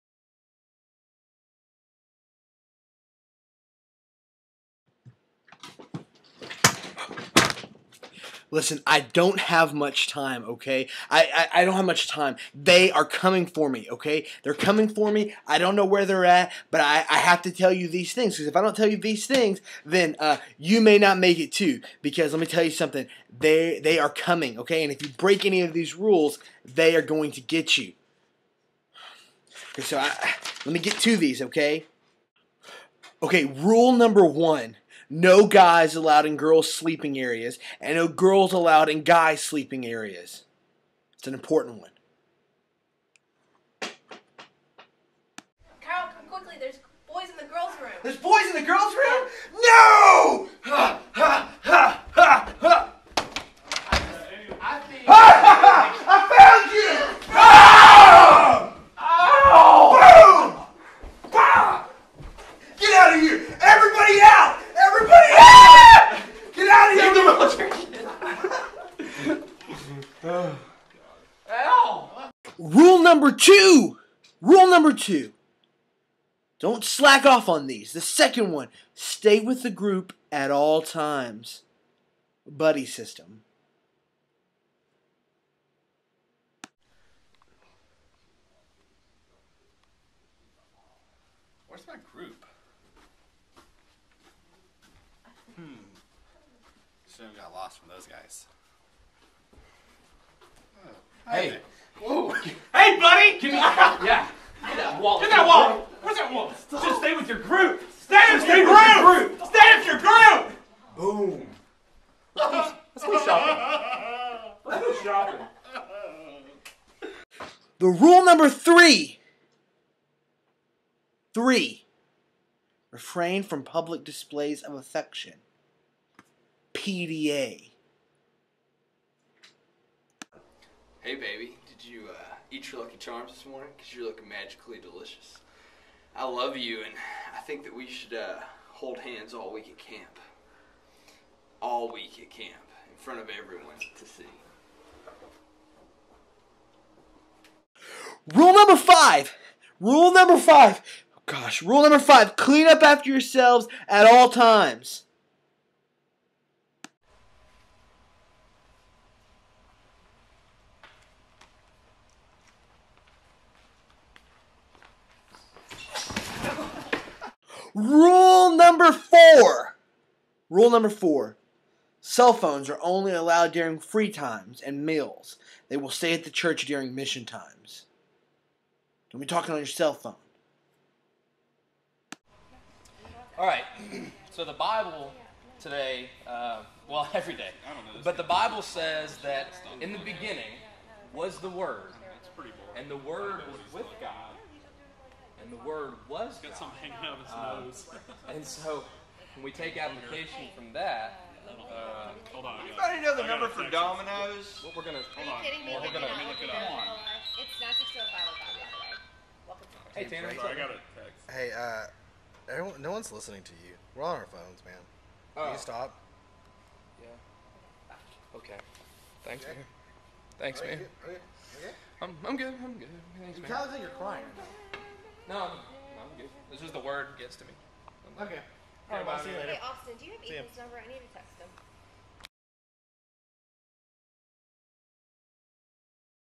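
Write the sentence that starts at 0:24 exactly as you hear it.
And if you break any of these rules, they are going to get you.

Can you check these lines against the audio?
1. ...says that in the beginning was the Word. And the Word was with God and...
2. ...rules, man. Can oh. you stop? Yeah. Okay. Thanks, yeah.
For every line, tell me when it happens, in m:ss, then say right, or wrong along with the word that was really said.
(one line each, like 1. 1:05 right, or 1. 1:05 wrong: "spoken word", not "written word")
1. 3:08 right
2. 3:34 wrong: "phones", not "rules".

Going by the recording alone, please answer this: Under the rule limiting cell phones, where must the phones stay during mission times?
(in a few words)
The church.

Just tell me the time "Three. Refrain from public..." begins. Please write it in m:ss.
2:01.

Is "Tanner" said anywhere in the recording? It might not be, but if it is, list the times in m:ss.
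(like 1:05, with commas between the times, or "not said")
3:30.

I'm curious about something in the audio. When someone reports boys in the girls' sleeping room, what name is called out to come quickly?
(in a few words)
Carl.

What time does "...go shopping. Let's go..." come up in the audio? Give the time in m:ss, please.
1:53.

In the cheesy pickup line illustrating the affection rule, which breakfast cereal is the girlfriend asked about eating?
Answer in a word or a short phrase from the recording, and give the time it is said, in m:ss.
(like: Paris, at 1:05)
Lucky Charms, at 2:12.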